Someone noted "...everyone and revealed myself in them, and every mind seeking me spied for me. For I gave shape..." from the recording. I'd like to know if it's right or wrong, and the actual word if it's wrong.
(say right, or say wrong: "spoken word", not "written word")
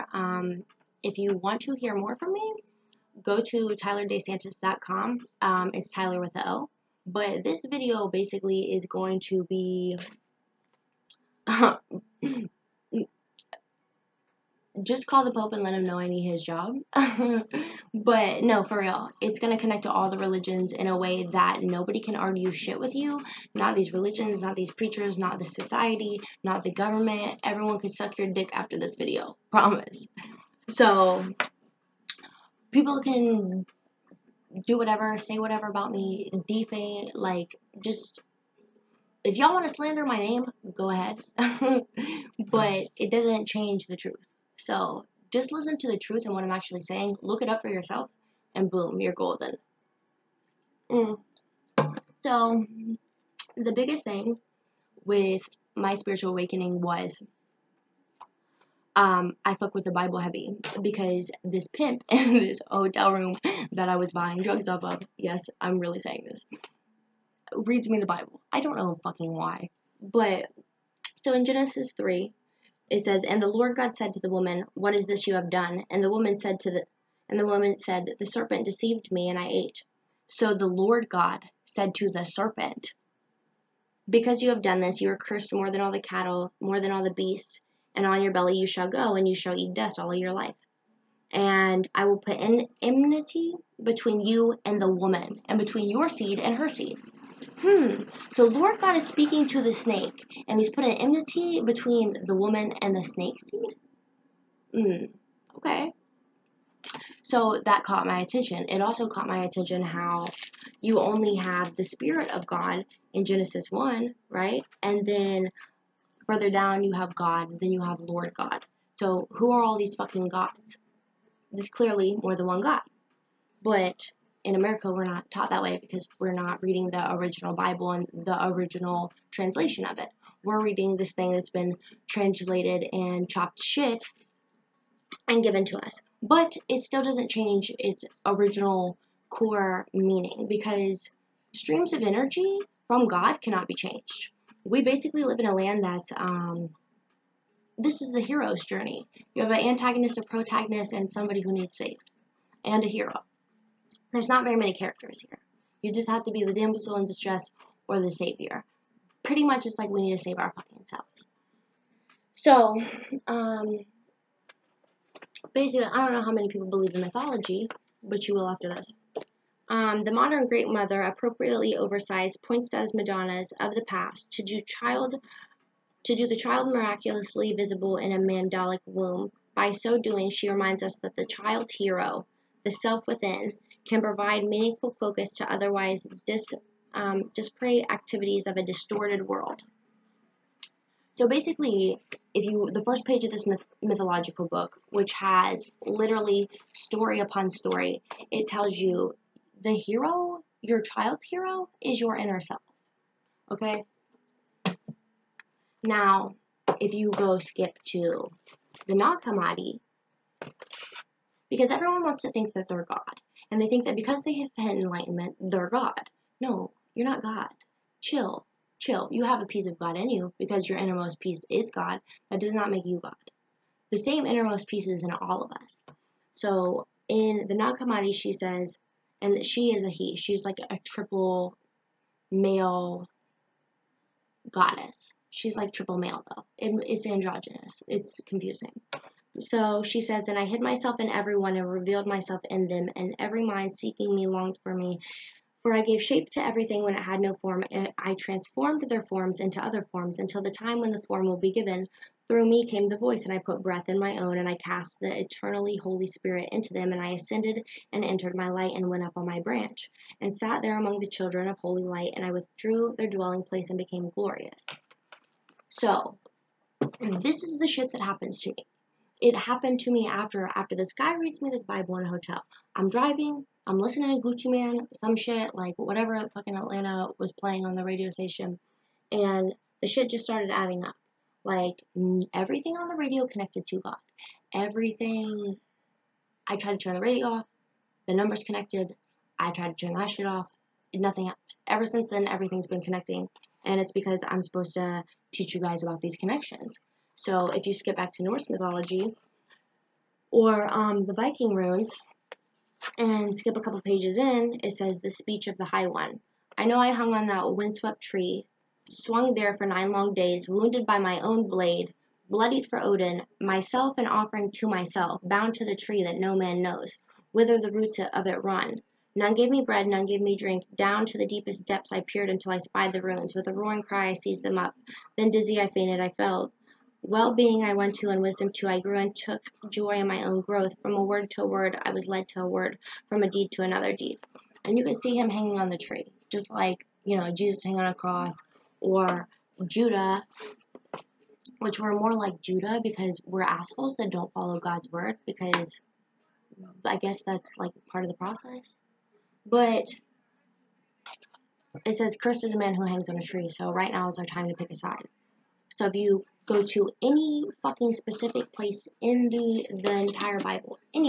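wrong: "longed", not "spied".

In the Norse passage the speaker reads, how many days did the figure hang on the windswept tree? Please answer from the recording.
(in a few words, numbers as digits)
9.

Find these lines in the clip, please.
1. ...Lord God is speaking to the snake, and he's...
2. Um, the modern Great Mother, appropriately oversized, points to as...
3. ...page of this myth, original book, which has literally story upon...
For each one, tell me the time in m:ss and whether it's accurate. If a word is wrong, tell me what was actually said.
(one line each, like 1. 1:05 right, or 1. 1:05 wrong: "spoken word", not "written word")
1. 1:38 right
2. 2:49 right
3. 3:13 wrong: "mythological", not "original".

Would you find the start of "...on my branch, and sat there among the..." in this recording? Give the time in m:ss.
4:19.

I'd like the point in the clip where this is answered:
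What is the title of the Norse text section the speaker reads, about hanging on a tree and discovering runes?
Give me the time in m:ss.
5:05.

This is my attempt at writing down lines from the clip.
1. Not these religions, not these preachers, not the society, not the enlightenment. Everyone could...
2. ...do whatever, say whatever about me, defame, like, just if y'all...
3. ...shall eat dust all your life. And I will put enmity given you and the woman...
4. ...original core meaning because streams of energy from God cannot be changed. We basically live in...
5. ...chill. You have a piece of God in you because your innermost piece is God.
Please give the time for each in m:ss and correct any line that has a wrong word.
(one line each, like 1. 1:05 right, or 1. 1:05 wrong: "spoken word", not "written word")
1. 0:23 wrong: "government", not "enlightenment"
2. 0:34 right
3. 1:29 wrong: "between", not "given"
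4. 2:18 right
5. 3:38 right.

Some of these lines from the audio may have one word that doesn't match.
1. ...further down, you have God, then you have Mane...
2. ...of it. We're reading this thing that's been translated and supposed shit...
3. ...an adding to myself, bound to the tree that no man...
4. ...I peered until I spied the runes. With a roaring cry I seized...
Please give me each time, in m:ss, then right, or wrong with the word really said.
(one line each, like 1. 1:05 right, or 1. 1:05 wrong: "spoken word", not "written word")
1. 1:56 wrong: "Lord", not "Mane"
2. 2:09 wrong: "chopped", not "supposed"
3. 5:13 wrong: "offering", not "adding"
4. 5:21 right.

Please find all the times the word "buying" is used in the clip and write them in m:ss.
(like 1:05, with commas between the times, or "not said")
1:04.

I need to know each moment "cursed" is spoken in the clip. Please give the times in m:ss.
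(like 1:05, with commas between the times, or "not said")
1:25, 5:52.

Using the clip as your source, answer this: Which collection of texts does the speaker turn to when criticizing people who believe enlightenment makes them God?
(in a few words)
Nag Hammadi.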